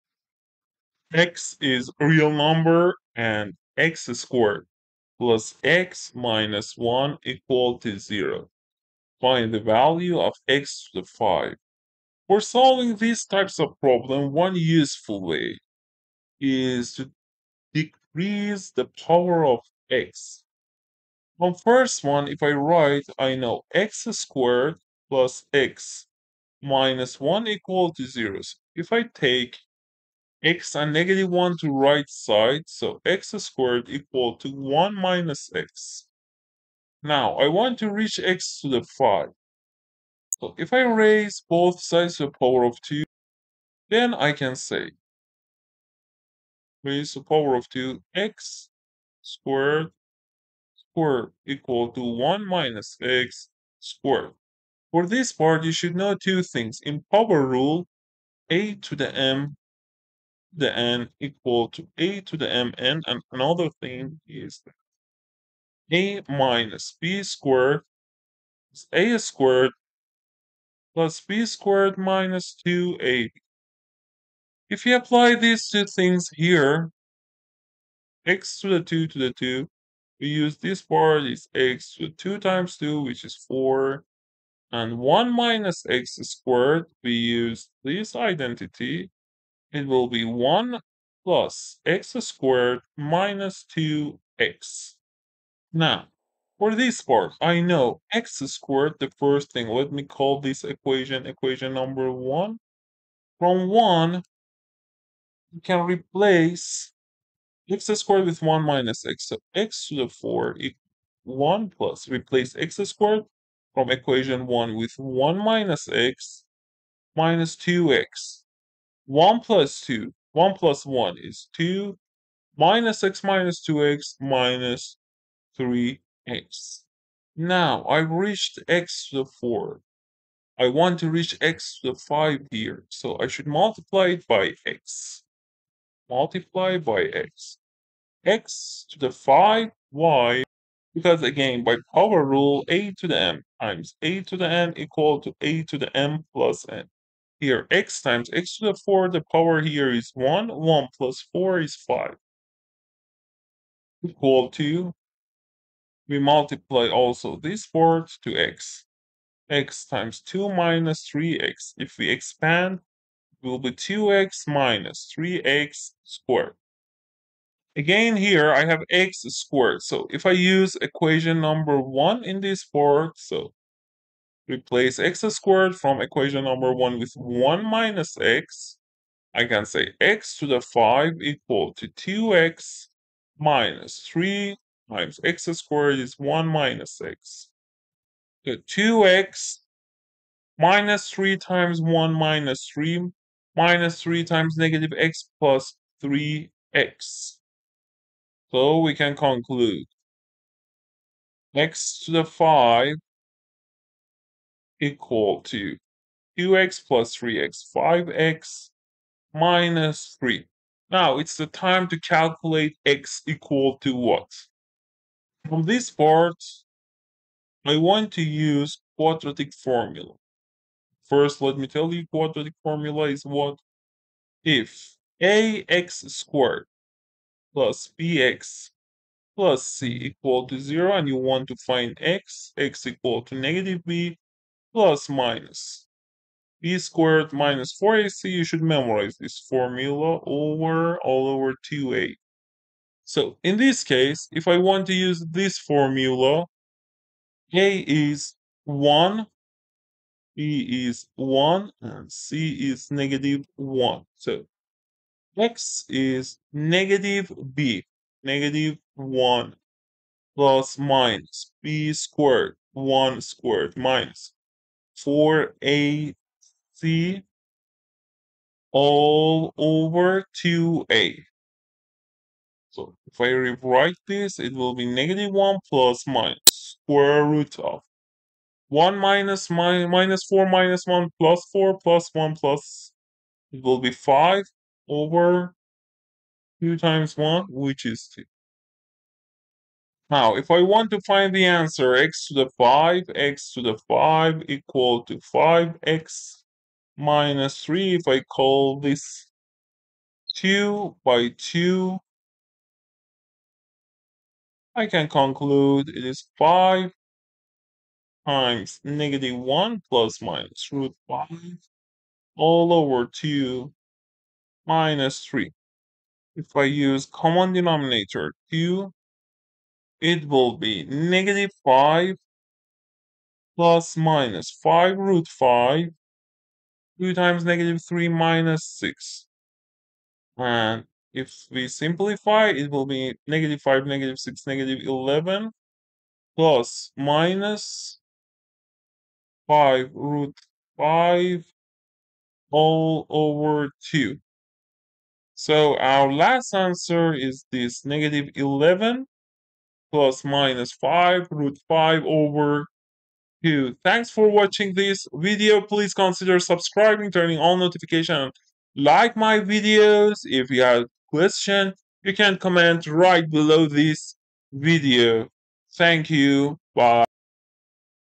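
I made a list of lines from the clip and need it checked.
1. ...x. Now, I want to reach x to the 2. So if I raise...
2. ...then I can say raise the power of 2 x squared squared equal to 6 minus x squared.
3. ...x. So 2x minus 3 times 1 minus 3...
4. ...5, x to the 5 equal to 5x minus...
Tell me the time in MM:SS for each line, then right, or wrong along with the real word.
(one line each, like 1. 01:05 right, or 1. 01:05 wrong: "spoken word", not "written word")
1. 00:35 wrong: "5", not "2"
2. 00:43 wrong: "1", not "6"
3. 03:07 right
4. 04:52 right.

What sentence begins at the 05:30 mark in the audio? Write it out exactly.
And if we simplify, it will be negative 5, negative 6, negative 11 plus minus 5 root 5 all over 2.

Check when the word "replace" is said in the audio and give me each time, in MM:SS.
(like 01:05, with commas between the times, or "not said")
01:45, 01:52, 02:54.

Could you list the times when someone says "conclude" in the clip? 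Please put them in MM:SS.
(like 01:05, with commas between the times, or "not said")
03:19, 05:05.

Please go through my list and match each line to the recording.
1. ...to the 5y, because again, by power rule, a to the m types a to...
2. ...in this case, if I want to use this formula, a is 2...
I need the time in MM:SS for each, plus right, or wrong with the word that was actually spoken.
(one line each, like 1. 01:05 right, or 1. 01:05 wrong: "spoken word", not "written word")
1. 02:18 wrong: "times", not "types"
2. 04:03 wrong: "1", not "2".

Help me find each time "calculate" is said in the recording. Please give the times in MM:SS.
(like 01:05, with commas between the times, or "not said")
03:32.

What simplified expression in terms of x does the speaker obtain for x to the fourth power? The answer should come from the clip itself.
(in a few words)
2 - 3x.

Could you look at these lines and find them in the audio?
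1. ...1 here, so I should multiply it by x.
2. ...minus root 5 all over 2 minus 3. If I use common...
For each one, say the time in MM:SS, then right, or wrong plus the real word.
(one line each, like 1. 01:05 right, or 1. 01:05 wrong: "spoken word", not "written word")
1. 02:11 wrong: "5", not "1"
2. 05:10 right.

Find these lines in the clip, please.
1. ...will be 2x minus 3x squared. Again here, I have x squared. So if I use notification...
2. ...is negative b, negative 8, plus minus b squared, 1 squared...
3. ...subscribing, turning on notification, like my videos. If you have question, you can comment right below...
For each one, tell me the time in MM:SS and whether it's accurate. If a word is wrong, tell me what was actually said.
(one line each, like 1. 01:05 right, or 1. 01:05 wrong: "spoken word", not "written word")
1. 02:43 wrong: "equation", not "notification"
2. 04:15 wrong: "1", not "8"
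3. 05:56 right.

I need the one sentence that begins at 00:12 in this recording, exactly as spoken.
For solving these types of problem, one useful way is to decrease the power of x.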